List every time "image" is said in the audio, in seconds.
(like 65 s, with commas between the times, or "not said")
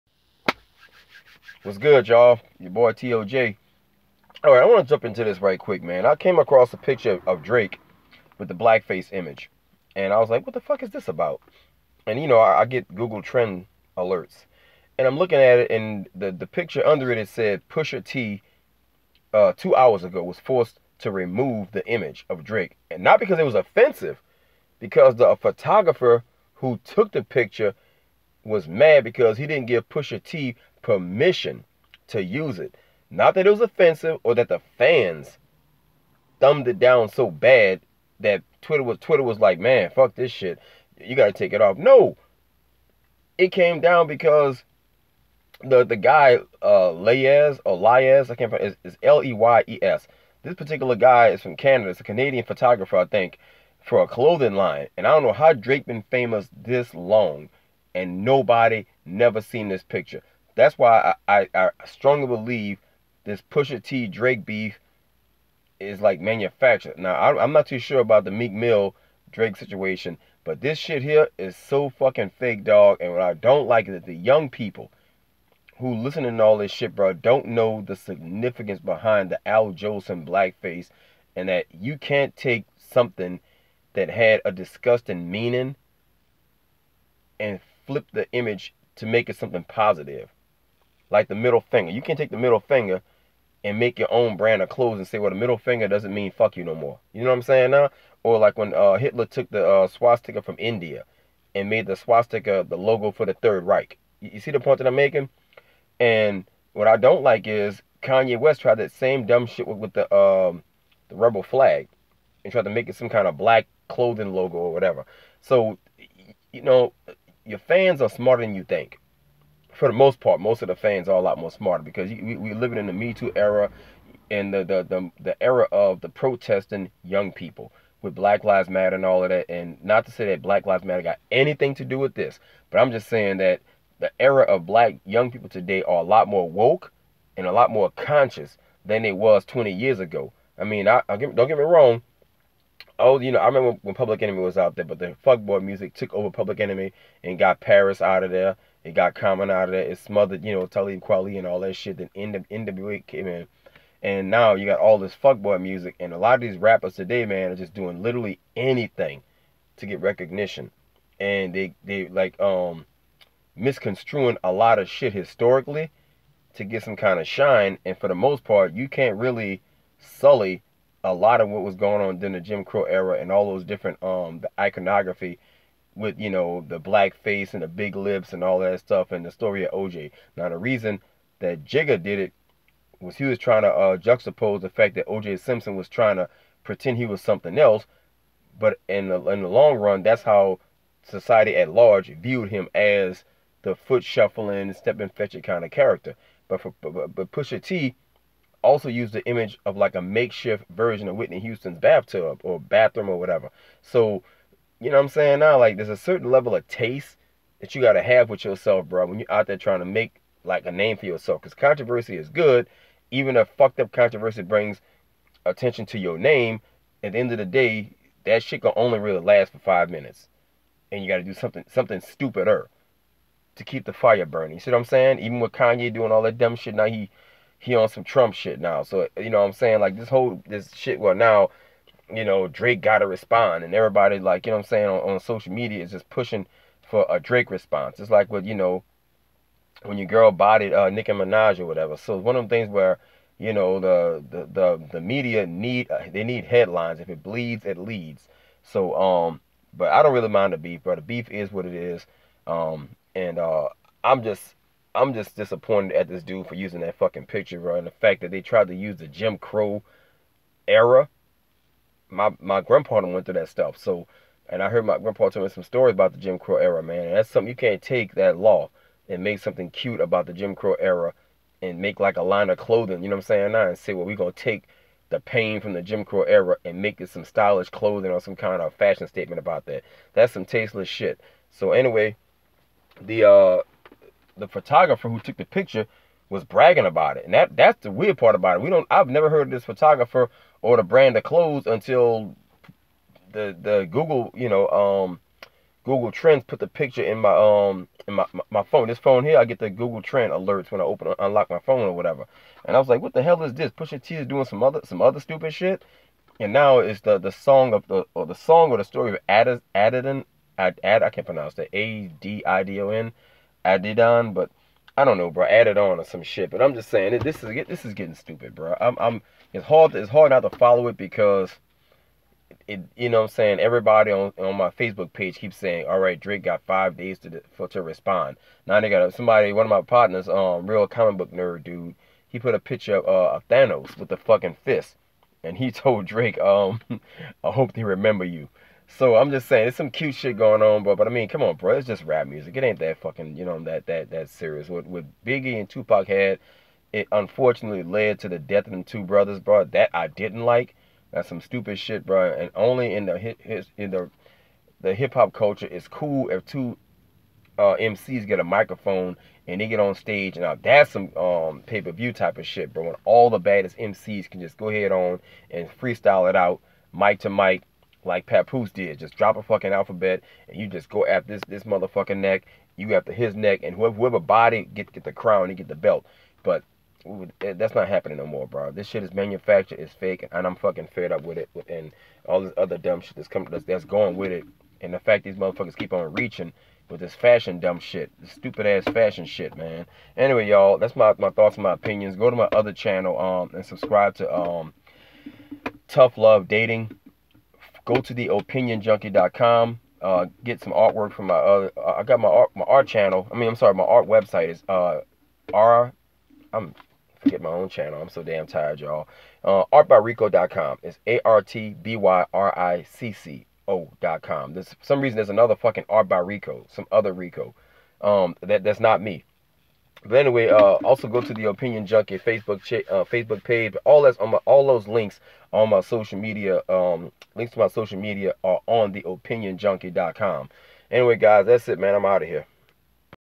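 9 s, 21 s, 88 s, 199 s.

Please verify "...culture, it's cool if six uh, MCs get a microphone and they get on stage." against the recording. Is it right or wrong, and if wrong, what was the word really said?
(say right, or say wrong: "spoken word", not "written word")
wrong: "two", not "six".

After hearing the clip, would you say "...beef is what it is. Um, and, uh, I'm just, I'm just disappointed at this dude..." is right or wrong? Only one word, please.
right.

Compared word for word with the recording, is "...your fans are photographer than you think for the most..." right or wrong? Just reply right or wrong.
wrong.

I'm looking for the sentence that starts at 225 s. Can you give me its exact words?
Even with Kanye doing all that dumb shit, now he he on some Trump shit now.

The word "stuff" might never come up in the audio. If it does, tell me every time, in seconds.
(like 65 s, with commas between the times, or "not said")
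178 s, 263 s.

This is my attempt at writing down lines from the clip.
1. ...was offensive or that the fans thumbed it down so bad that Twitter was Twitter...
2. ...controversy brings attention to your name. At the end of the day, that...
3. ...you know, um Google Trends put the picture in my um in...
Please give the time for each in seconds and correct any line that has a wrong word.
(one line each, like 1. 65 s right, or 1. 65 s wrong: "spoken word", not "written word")
1. 33 s right
2. 213 s right
3. 294 s right.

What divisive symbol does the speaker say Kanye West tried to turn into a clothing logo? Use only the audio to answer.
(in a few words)
Rebel flag.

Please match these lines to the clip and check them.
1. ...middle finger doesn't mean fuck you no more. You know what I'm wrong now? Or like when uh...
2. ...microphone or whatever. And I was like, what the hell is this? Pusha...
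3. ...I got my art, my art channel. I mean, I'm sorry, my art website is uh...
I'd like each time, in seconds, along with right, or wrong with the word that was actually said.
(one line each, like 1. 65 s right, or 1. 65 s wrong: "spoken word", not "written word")
1. 95 s wrong: "saying", not "wrong"
2. 301 s wrong: "phone", not "microphone"
3. 401 s right.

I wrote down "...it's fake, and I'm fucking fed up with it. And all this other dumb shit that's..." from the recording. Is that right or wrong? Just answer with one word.
right.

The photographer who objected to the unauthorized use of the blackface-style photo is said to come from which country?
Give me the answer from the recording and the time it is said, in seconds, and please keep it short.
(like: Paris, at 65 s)
Canada, at 51 s.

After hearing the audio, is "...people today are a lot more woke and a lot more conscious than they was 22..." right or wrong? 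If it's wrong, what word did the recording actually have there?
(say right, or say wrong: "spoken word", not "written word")
wrong: "20", not "22".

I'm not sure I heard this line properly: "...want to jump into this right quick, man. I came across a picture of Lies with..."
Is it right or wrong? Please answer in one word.
wrong.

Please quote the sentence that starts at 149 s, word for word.
It smothered, you know, Talib Kweli and all that shit.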